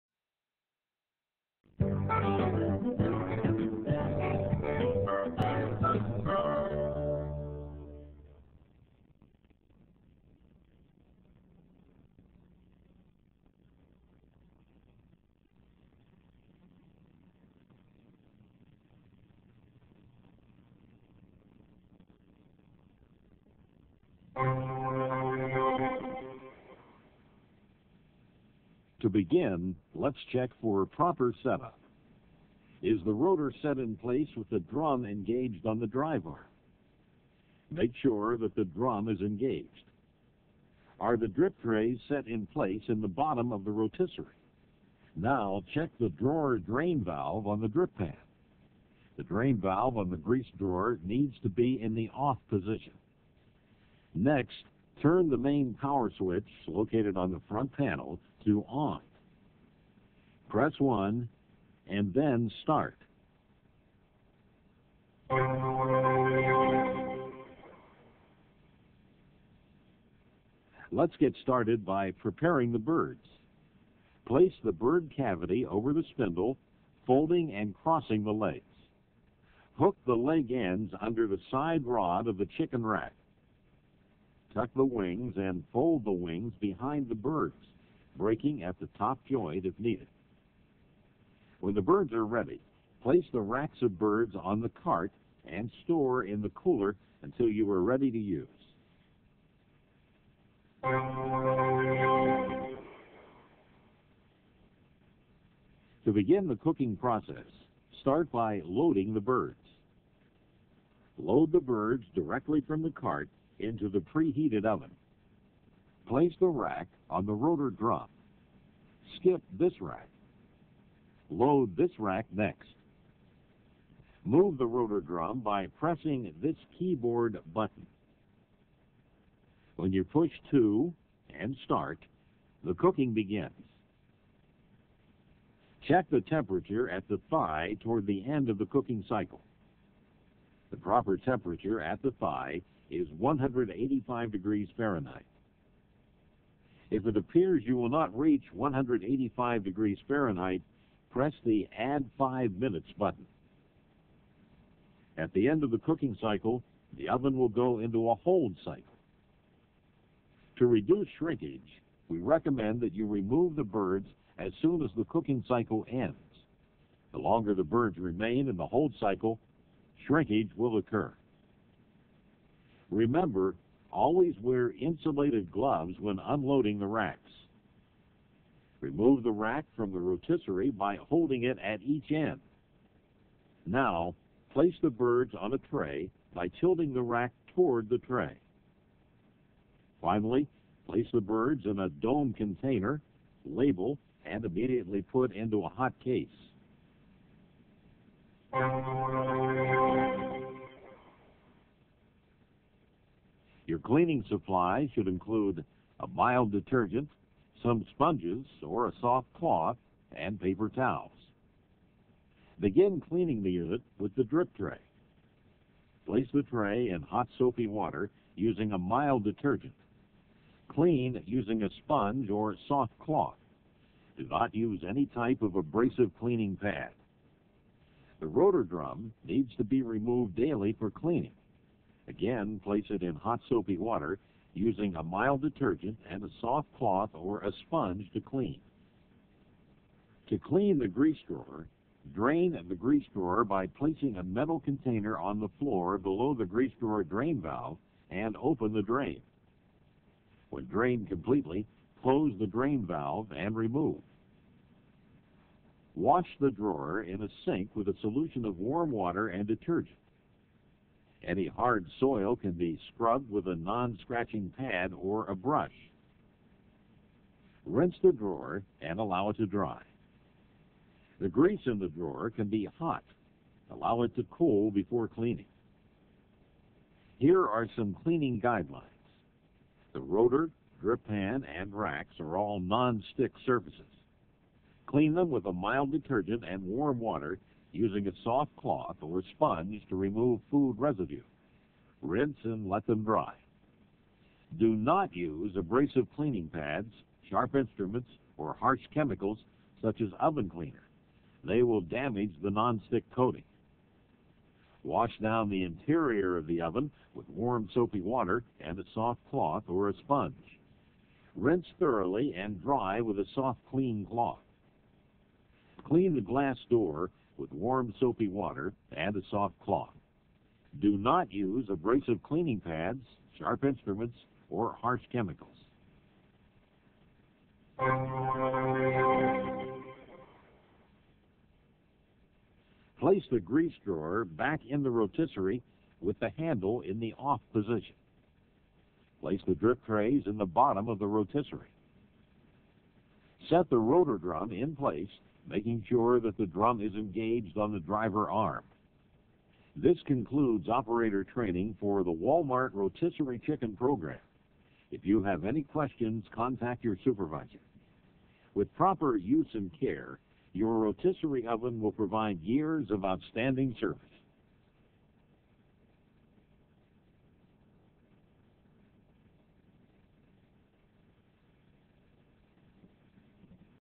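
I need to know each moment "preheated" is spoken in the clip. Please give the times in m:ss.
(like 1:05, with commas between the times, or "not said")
1:54.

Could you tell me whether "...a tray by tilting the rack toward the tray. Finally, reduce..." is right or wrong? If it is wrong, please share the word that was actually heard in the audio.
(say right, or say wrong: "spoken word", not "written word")
wrong: "place", not "reduce".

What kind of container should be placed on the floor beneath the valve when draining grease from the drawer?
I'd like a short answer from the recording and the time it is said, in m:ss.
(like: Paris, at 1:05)
metal container, at 4:04.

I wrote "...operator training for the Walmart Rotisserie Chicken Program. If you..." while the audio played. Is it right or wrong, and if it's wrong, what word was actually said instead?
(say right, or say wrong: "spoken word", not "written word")
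right.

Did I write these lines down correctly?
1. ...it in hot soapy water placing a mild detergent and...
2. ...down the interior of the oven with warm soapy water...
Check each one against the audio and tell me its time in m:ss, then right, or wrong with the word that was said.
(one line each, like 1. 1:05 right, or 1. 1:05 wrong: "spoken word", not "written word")
1. 3:52 wrong: "using", not "placing"
2. 5:05 right.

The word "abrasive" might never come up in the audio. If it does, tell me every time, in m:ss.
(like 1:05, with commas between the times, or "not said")
3:45, 4:55, 5:21.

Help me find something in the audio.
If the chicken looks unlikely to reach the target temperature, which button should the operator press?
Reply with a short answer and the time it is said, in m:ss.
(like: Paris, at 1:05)
Add 5 Minutes, at 2:31.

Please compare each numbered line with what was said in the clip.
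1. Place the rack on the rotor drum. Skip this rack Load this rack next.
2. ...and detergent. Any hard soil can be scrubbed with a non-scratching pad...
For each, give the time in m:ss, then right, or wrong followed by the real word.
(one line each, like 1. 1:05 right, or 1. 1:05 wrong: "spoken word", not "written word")
1. 1:56 right
2. 4:19 right.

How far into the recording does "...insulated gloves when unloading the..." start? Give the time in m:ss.
2:54.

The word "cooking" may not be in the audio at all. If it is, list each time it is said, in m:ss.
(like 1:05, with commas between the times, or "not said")
1:46, 2:12, 2:18, 2:35, 2:45.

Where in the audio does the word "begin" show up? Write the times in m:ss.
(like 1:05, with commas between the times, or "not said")
0:29, 1:46, 2:13, 3:32.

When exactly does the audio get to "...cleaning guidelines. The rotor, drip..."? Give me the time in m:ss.
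4:38.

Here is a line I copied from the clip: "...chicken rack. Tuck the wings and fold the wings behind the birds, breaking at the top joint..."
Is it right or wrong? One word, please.
right.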